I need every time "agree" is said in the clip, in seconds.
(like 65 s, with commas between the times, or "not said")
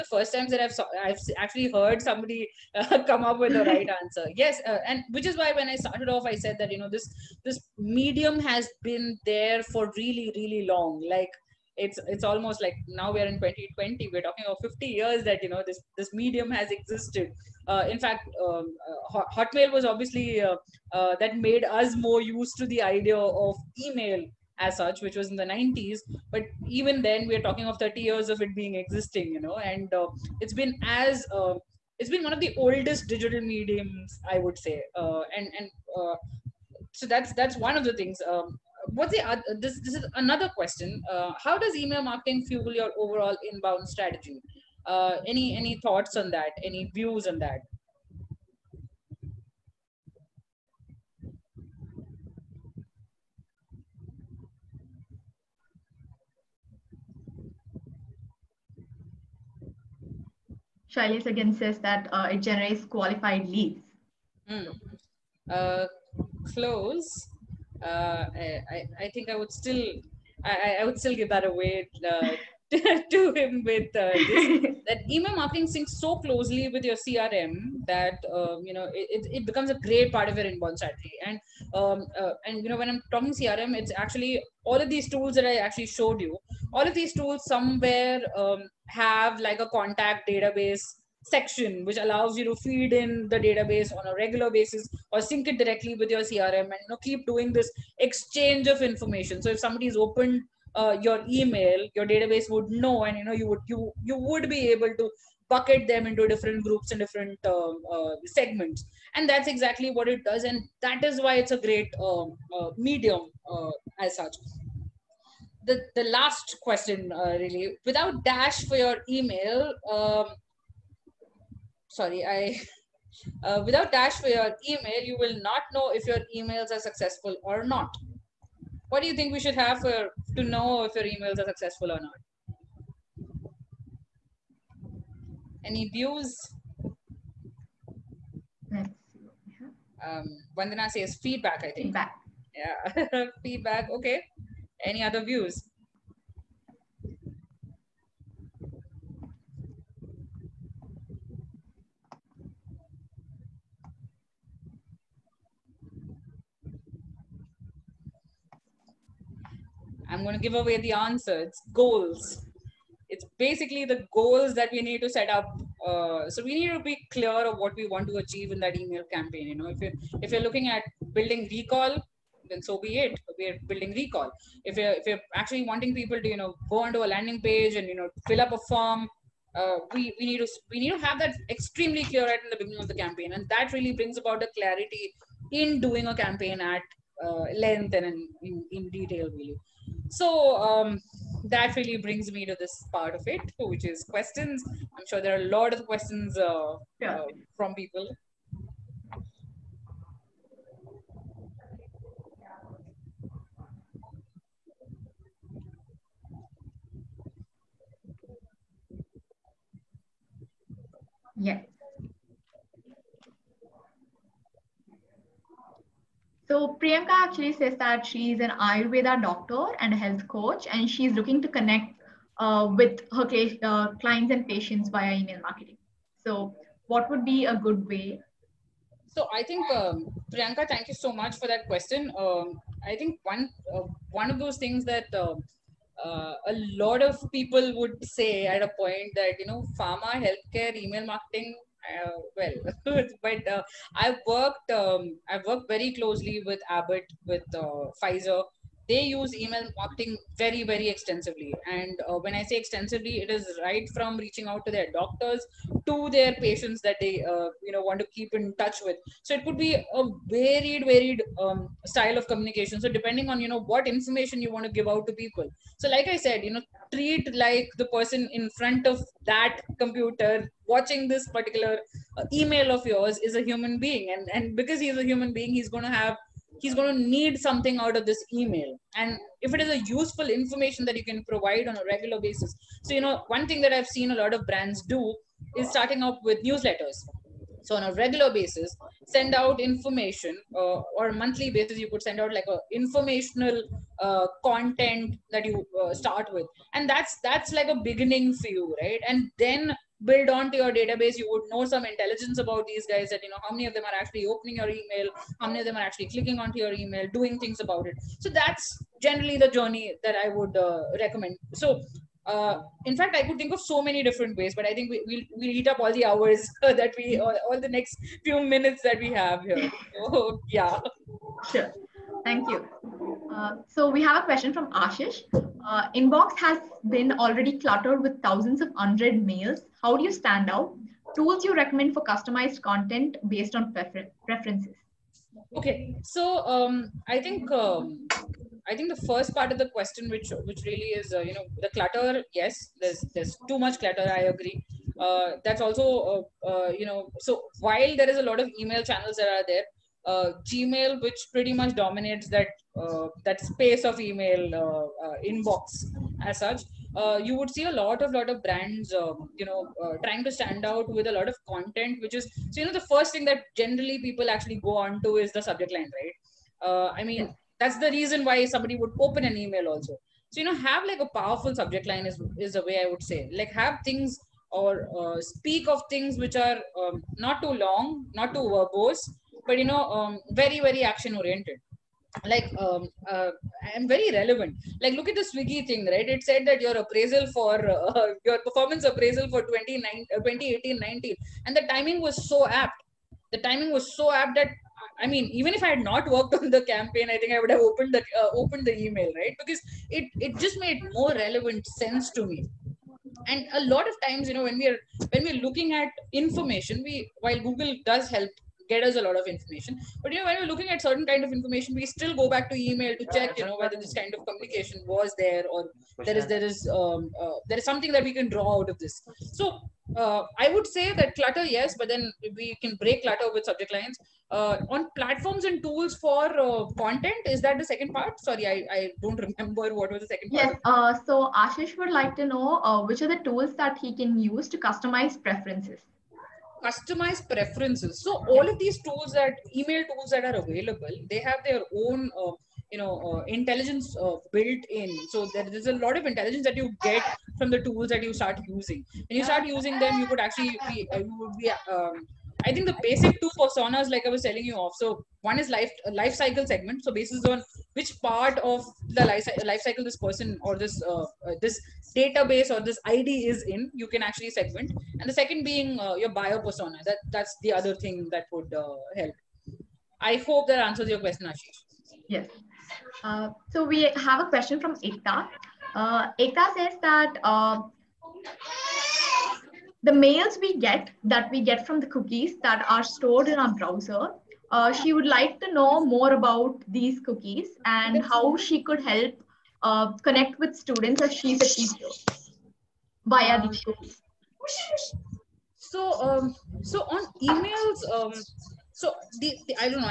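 344 s.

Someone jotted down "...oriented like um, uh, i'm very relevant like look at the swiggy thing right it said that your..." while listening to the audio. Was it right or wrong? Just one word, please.
right.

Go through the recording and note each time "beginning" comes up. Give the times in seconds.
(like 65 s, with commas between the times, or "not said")
182 s, 297 s.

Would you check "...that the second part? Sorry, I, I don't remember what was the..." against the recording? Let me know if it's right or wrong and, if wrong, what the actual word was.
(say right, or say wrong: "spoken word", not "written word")
right.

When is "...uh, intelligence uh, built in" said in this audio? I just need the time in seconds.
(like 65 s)
443 s.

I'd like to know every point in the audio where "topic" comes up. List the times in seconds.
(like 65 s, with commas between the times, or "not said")
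not said.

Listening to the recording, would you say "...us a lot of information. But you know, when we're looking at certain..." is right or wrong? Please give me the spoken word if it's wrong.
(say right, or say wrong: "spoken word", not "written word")
right.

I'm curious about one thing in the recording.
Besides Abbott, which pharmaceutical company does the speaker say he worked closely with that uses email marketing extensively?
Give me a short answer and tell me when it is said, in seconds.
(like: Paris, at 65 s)
Pfizer, at 248 s.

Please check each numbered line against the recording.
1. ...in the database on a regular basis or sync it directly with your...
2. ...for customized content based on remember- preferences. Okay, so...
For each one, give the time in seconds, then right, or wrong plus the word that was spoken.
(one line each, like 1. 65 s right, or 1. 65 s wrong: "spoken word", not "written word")
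1. 92 s right
2. 331 s wrong: "prefer", not "remember".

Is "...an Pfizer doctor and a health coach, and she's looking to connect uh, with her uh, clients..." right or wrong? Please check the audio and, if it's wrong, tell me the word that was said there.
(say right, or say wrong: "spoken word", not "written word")
wrong: "Ayurveda", not "Pfizer".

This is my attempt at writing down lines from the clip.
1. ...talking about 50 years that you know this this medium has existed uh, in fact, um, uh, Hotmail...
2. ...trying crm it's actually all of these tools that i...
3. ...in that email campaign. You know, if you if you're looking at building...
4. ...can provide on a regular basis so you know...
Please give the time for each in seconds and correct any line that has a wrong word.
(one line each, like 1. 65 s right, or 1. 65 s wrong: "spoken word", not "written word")
1. 14 s right
2. 83 s wrong: "talking", not "trying"
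3. 168 s right
4. 281 s right.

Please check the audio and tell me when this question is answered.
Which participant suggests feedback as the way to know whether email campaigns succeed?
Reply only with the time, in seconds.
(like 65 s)
140 s.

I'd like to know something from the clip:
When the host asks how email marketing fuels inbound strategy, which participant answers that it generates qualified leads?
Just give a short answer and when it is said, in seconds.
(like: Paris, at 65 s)
Shailesh, at 60 s.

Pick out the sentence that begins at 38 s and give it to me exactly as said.
Um, what's the other, this this is another question?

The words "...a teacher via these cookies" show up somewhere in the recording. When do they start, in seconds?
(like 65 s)
491 s.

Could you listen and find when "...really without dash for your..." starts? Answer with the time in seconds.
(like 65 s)
117 s.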